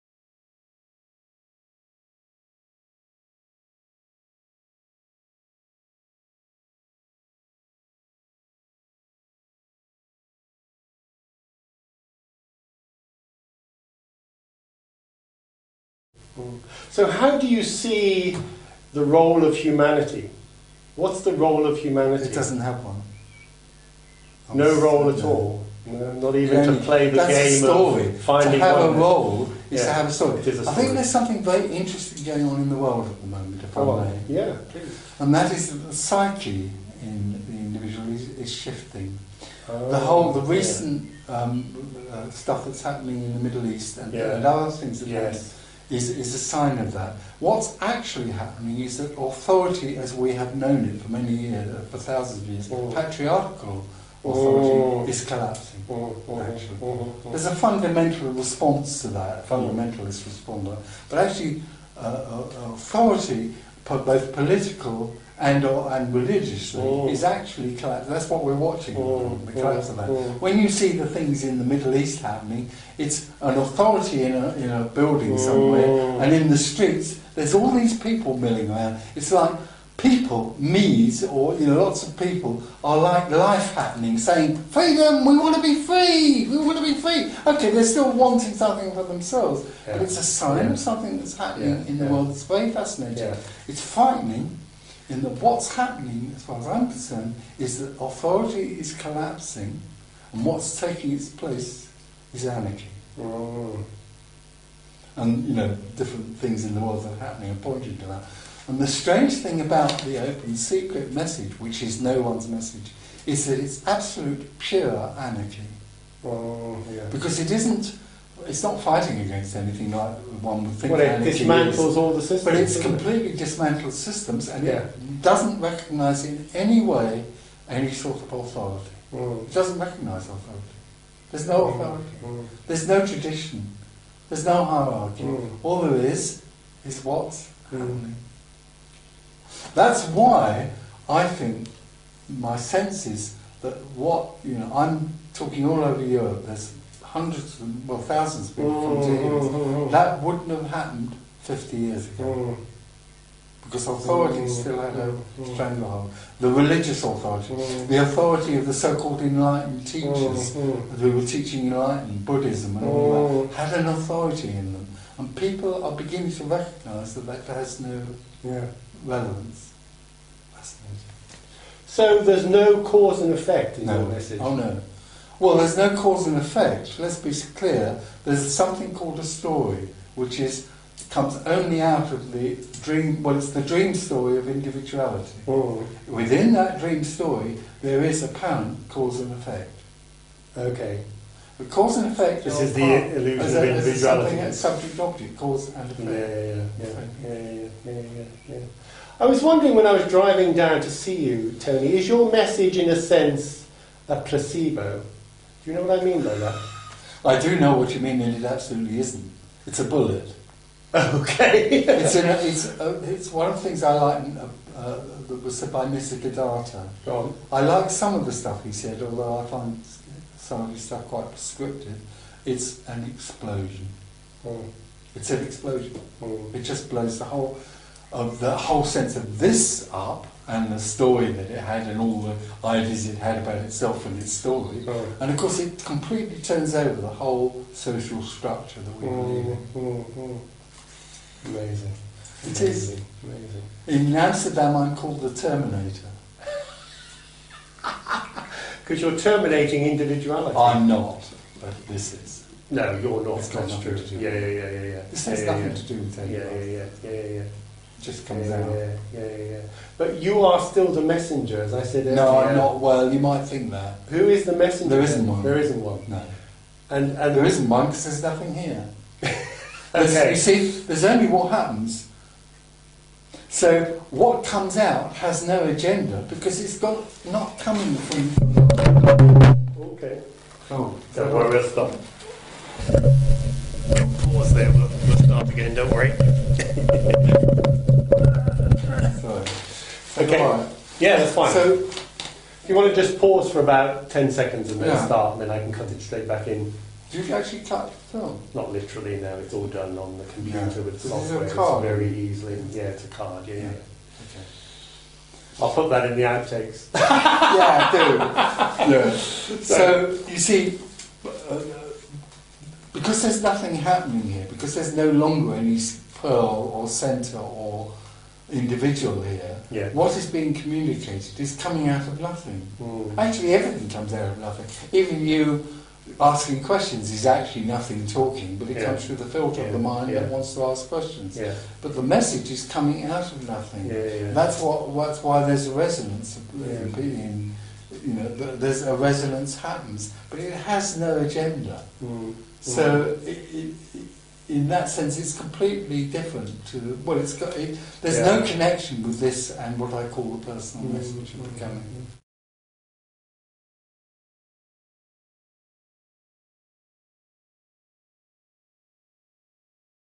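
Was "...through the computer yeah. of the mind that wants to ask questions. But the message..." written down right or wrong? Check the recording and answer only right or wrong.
wrong.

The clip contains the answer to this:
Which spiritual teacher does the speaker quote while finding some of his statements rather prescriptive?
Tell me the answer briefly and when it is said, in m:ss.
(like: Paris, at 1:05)
Nisargadatta, at 3:35.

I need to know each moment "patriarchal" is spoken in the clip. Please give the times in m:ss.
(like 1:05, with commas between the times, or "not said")
0:52.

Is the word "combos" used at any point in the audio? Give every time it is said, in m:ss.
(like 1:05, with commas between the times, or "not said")
not said.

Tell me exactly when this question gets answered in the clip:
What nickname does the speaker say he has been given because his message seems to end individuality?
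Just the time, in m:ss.
4:05.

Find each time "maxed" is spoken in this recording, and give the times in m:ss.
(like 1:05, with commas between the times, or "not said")
not said.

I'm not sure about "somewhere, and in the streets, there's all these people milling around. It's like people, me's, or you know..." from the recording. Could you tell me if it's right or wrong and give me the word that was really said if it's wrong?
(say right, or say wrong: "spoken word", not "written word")
right.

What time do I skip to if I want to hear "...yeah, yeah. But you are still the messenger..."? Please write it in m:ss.
4:19.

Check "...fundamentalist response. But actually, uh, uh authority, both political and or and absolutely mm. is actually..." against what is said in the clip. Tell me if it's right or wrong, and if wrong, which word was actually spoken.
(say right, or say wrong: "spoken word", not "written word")
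wrong: "religiously", not "absolutely".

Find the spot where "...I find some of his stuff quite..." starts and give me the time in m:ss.
3:39.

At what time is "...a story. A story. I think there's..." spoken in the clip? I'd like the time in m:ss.
0:30.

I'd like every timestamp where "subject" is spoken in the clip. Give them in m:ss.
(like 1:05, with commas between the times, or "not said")
3:14.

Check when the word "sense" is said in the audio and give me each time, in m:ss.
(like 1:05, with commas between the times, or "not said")
2:22, 3:22, 3:48, 5:44.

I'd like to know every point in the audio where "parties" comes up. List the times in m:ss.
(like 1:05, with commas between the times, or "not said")
not said.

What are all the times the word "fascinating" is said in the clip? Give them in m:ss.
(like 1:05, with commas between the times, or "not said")
1:32, 2:50.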